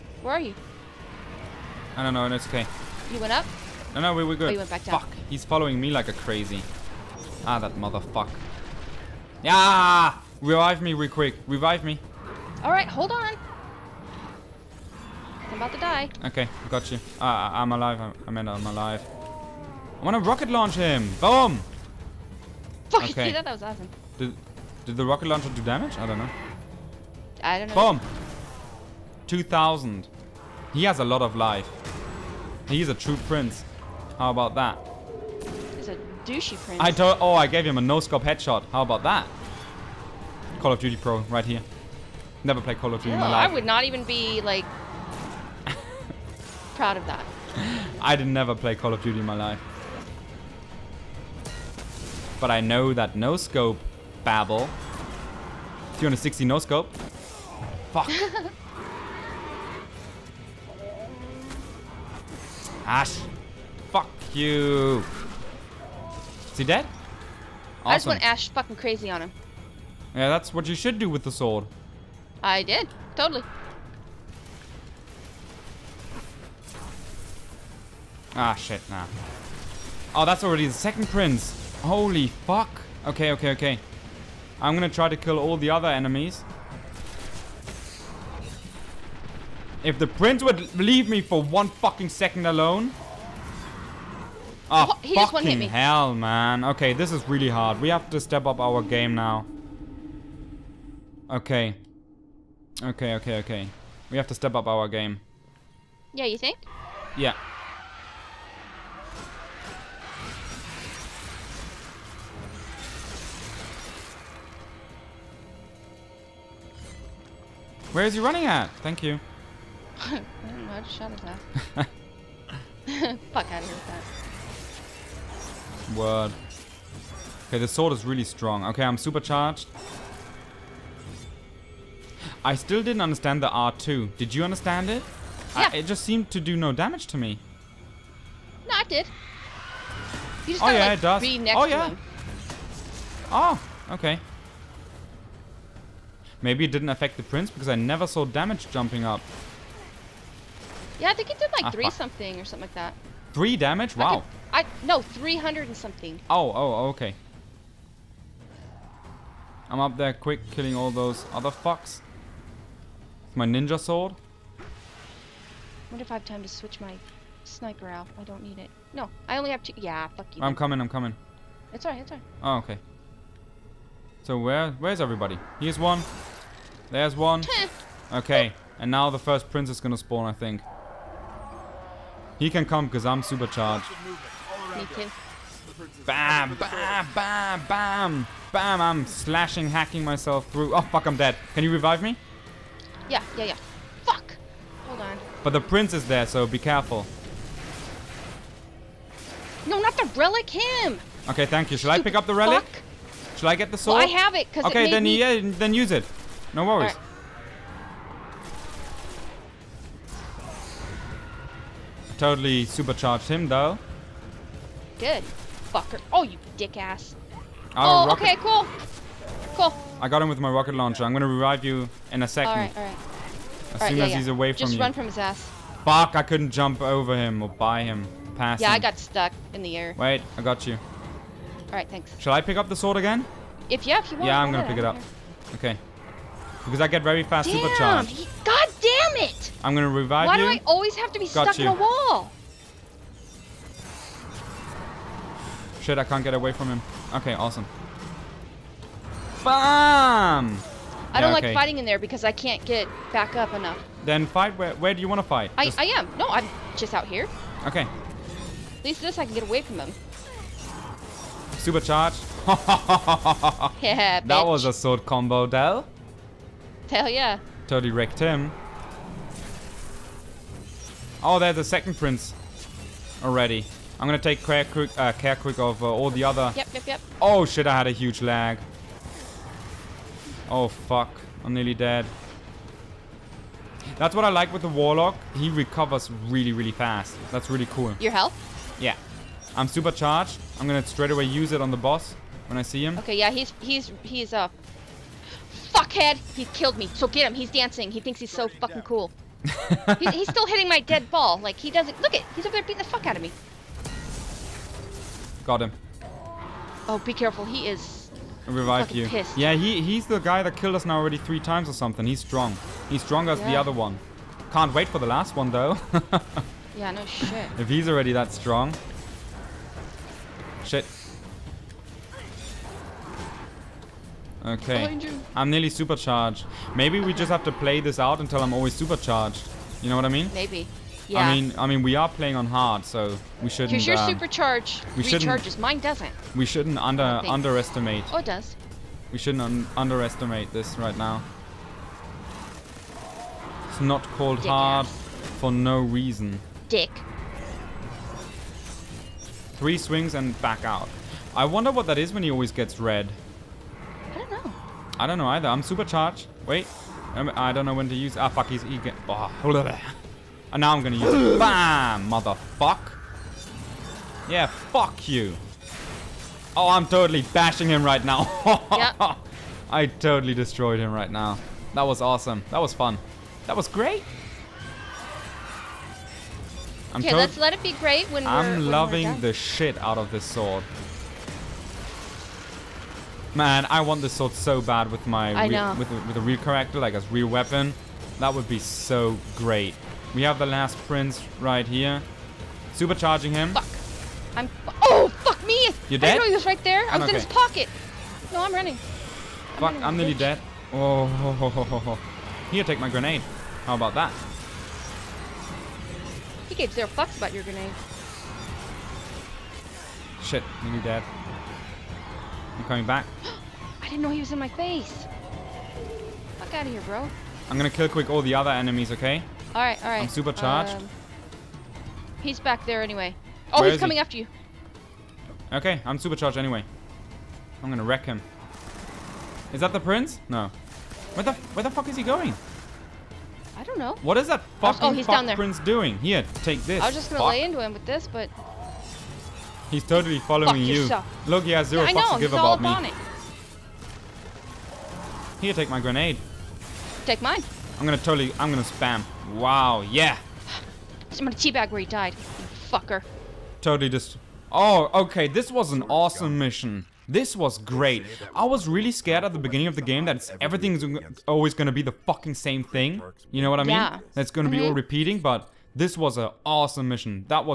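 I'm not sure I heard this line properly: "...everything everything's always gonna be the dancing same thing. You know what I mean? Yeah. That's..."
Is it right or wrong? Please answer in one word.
wrong.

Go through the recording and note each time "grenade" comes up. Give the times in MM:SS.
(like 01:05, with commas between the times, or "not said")
06:42, 06:47, 07:25.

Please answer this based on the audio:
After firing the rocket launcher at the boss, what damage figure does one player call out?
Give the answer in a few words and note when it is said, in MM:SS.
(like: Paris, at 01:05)
2000, at 00:29.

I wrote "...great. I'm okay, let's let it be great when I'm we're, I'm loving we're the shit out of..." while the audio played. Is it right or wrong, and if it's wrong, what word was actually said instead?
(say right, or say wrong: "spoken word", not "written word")
right.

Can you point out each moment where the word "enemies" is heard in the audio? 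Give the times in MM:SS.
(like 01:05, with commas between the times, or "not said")
01:25, 06:58.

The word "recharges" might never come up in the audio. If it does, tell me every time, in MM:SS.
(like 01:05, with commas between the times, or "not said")
05:35.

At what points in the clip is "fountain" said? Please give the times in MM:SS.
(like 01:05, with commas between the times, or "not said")
not said.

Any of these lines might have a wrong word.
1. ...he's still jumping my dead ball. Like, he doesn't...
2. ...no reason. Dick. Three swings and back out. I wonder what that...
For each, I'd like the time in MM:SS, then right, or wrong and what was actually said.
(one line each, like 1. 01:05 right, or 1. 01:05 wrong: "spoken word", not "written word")
1. 04:59 wrong: "hitting", not "jumping"
2. 05:45 right.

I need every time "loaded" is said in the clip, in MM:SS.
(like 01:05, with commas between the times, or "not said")
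not said.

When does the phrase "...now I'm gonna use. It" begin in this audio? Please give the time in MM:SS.
06:00.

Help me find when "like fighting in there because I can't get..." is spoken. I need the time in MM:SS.
04:11.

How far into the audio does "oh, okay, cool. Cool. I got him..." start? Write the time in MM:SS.
03:37.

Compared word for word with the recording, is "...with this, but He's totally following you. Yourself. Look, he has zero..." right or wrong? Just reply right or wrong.
right.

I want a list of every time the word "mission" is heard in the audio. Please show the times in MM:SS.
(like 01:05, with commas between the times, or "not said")
07:36, 07:46.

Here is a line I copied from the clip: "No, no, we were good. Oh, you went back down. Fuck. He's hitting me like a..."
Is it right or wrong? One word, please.
wrong.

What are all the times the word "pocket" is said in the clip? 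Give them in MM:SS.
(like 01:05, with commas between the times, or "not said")
06:37.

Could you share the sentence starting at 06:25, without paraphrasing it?
With, with a real character, like as real weapon.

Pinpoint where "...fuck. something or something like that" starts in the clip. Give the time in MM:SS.
02:31.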